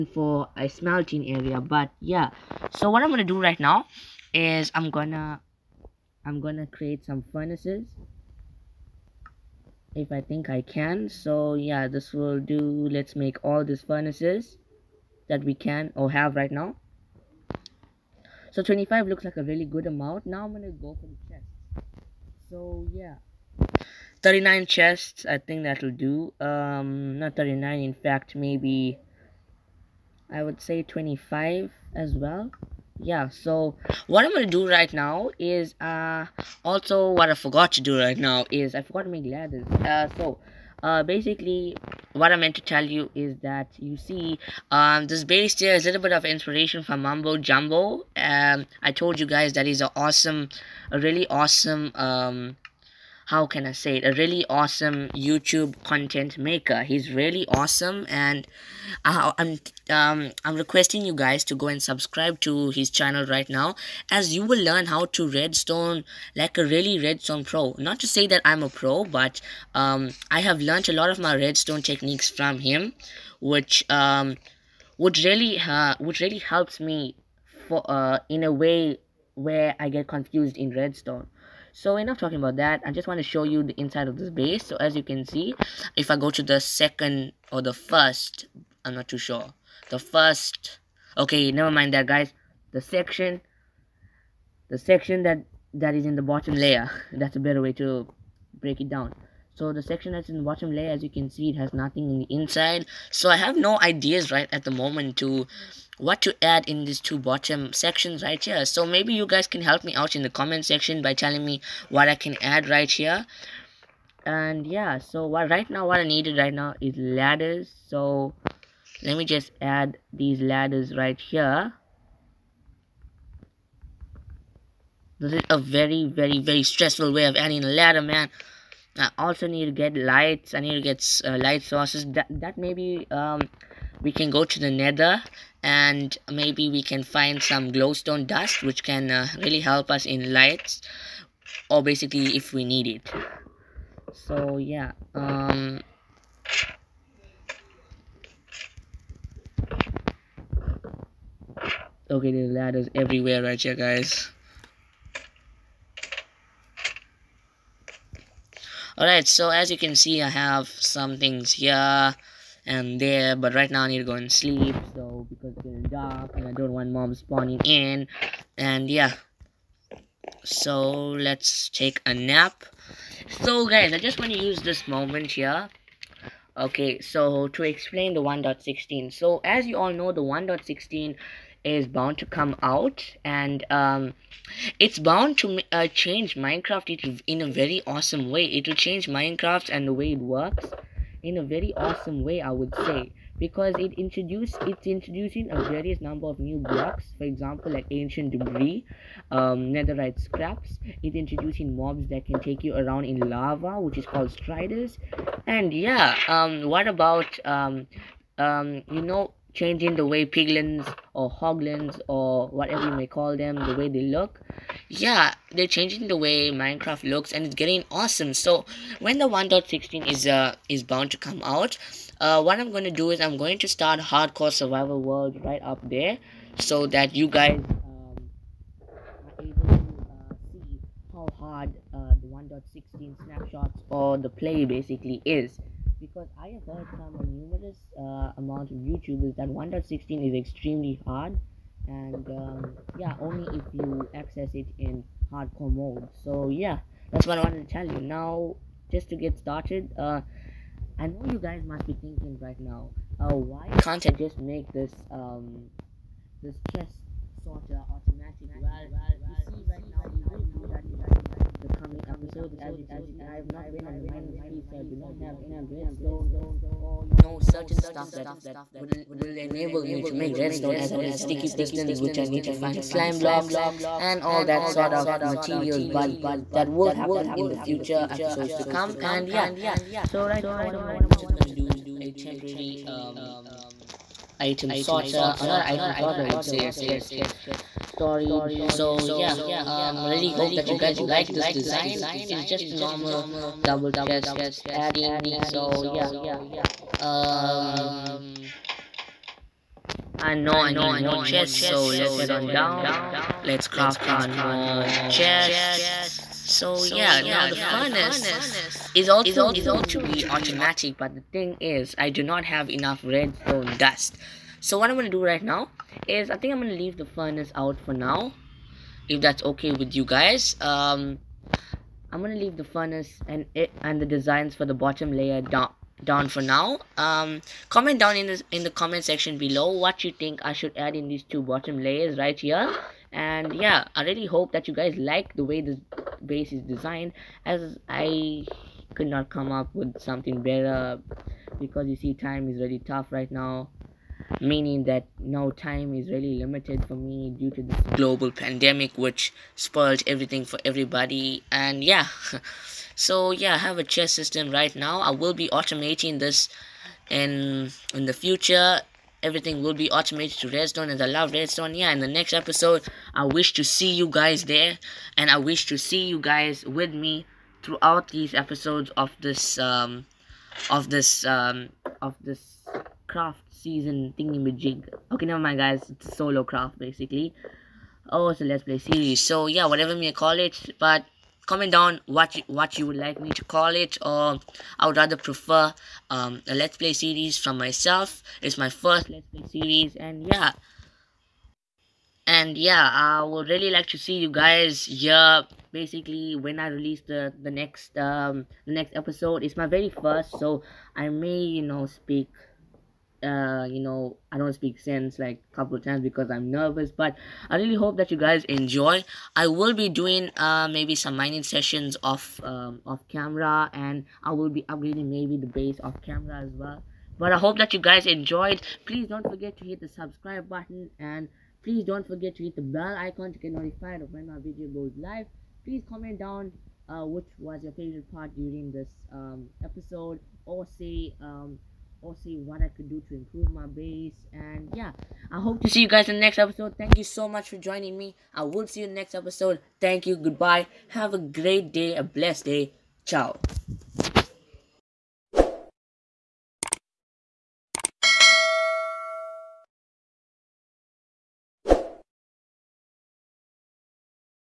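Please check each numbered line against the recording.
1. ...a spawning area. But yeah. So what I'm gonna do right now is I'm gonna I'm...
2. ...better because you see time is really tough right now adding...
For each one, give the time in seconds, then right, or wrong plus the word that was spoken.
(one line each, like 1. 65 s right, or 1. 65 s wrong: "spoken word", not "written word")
1. 0 s wrong: "smelting", not "spawning"
2. 340 s wrong: "meaning", not "adding".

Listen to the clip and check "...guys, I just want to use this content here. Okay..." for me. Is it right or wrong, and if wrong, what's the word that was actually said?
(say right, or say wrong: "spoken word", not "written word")
wrong: "moment", not "content".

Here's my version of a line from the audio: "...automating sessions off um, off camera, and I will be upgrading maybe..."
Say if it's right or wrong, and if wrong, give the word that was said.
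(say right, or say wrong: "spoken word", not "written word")
wrong: "mining", not "automating".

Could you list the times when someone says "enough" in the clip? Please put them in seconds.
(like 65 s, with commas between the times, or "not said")
81 s, 312 s.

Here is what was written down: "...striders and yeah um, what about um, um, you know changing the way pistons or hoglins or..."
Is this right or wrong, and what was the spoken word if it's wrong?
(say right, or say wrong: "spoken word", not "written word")
wrong: "piglins", not "pistons".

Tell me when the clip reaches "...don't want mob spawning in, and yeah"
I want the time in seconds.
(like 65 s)
166 s.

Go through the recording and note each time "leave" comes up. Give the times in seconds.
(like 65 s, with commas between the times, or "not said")
316 s, 322 s.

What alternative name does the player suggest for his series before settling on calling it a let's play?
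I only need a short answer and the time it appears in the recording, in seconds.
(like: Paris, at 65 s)
Solo craft, at 376 s.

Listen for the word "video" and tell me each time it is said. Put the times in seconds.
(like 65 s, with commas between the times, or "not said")
424 s.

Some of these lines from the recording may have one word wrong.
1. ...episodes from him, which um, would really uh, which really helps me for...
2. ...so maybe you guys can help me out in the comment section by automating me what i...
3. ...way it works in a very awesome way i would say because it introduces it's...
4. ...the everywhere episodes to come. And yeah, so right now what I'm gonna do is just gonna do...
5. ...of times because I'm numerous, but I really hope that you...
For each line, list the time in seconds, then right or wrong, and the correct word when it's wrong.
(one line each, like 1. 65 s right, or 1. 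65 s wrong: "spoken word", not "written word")
1. 71 s wrong: "techniques", not "episodes"
2. 108 s wrong: "telling", not "automating"
3. 189 s right
4. 277 s wrong: "future", not "everywhere"
5. 405 s wrong: "nervous", not "numerous".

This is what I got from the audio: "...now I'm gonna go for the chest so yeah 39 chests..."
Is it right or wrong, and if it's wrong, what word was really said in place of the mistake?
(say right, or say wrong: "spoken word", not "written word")
right.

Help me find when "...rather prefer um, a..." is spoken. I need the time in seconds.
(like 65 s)
384 s.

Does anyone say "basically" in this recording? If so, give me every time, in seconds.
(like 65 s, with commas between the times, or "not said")
41 s, 141 s, 234 s, 376 s, 395 s.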